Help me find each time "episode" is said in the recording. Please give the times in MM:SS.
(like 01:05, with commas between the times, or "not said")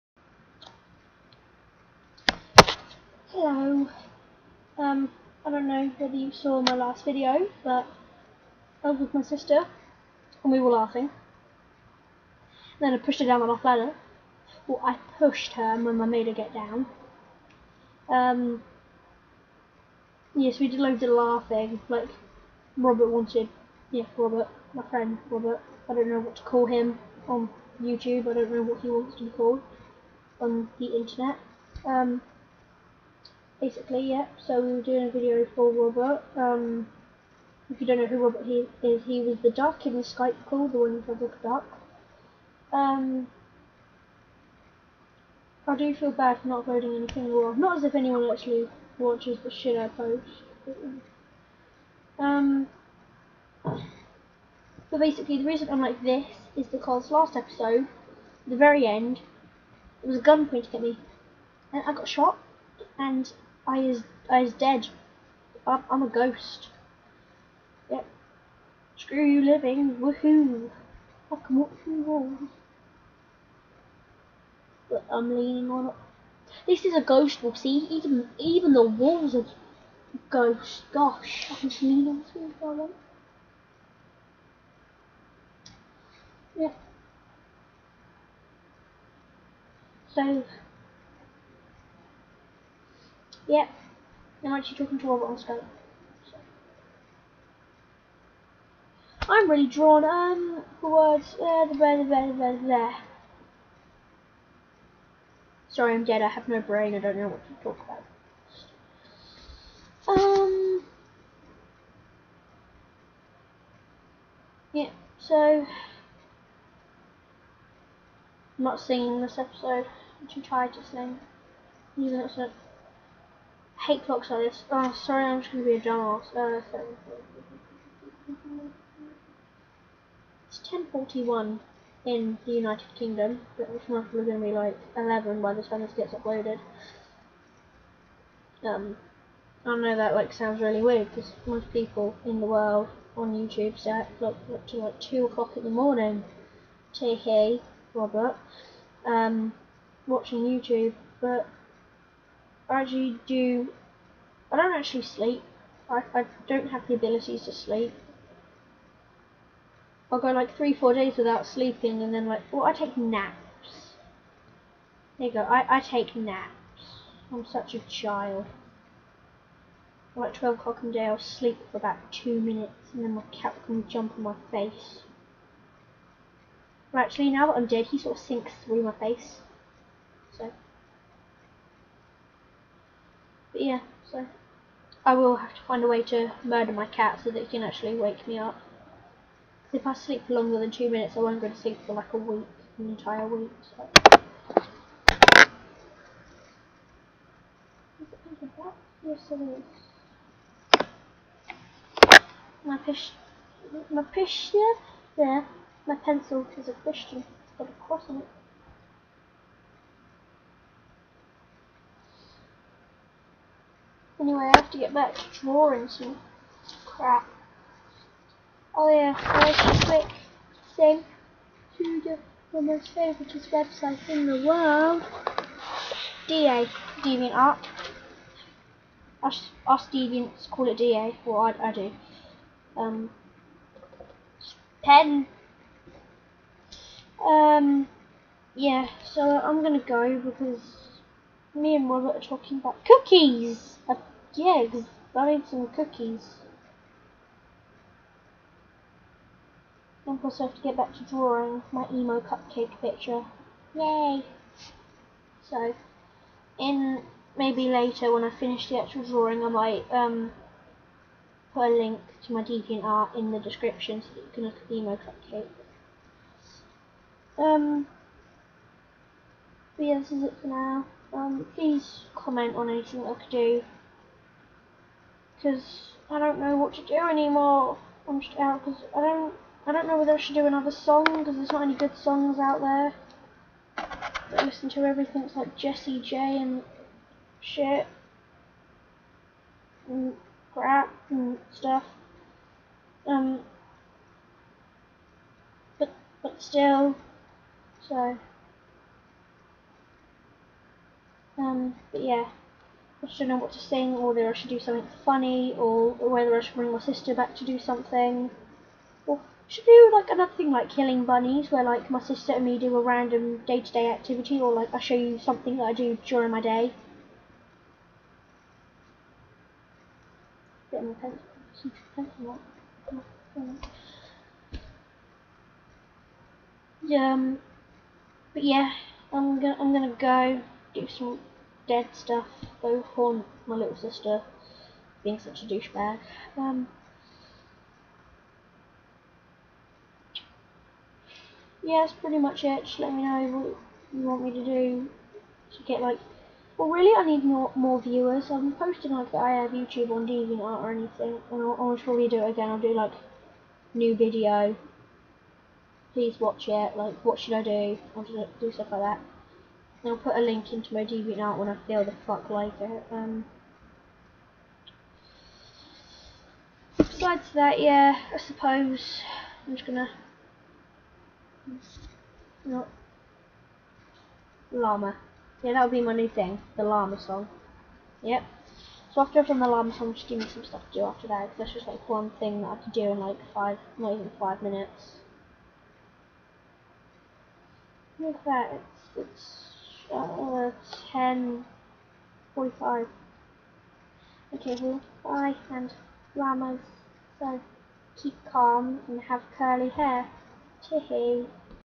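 00:57, 01:59.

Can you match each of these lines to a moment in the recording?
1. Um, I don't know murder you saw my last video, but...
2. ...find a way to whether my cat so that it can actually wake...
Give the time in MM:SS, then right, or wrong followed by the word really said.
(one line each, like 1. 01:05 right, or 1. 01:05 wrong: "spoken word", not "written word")
1. 00:04 wrong: "whether", not "murder"
2. 03:05 wrong: "murder", not "whether".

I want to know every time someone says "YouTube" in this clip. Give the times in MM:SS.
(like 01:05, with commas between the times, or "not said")
00:27, 02:23, 02:30, 05:49.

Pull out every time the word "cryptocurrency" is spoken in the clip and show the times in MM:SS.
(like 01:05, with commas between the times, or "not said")
not said.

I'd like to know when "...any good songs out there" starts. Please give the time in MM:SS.
04:41.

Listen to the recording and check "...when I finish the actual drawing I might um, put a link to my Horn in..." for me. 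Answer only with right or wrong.
wrong.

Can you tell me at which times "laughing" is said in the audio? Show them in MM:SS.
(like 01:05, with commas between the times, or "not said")
00:10, 00:21.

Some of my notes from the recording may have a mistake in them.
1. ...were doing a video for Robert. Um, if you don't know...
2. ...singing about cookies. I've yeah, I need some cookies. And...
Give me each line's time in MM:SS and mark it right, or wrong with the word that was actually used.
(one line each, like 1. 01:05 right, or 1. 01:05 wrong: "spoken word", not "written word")
1. 00:34 right
2. 04:02 wrong: "talking", not "singing".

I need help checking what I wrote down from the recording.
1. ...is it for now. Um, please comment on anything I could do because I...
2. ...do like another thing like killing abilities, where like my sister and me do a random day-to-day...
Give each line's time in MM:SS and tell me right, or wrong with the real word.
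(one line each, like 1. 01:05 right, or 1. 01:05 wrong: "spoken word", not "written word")
1. 04:30 right
2. 05:09 wrong: "bunnies", not "abilities".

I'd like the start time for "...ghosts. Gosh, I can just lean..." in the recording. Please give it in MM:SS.
01:20.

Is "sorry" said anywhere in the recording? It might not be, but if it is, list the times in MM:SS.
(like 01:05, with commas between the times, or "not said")
01:45, 02:04.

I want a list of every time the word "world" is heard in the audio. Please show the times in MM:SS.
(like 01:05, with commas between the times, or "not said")
02:22, 03:44.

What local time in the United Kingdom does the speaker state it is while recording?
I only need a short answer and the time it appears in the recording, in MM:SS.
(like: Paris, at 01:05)
10.41, at 02:10.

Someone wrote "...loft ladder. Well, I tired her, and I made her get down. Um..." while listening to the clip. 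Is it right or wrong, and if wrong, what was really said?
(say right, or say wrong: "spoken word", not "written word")
wrong: "pushed", not "tired".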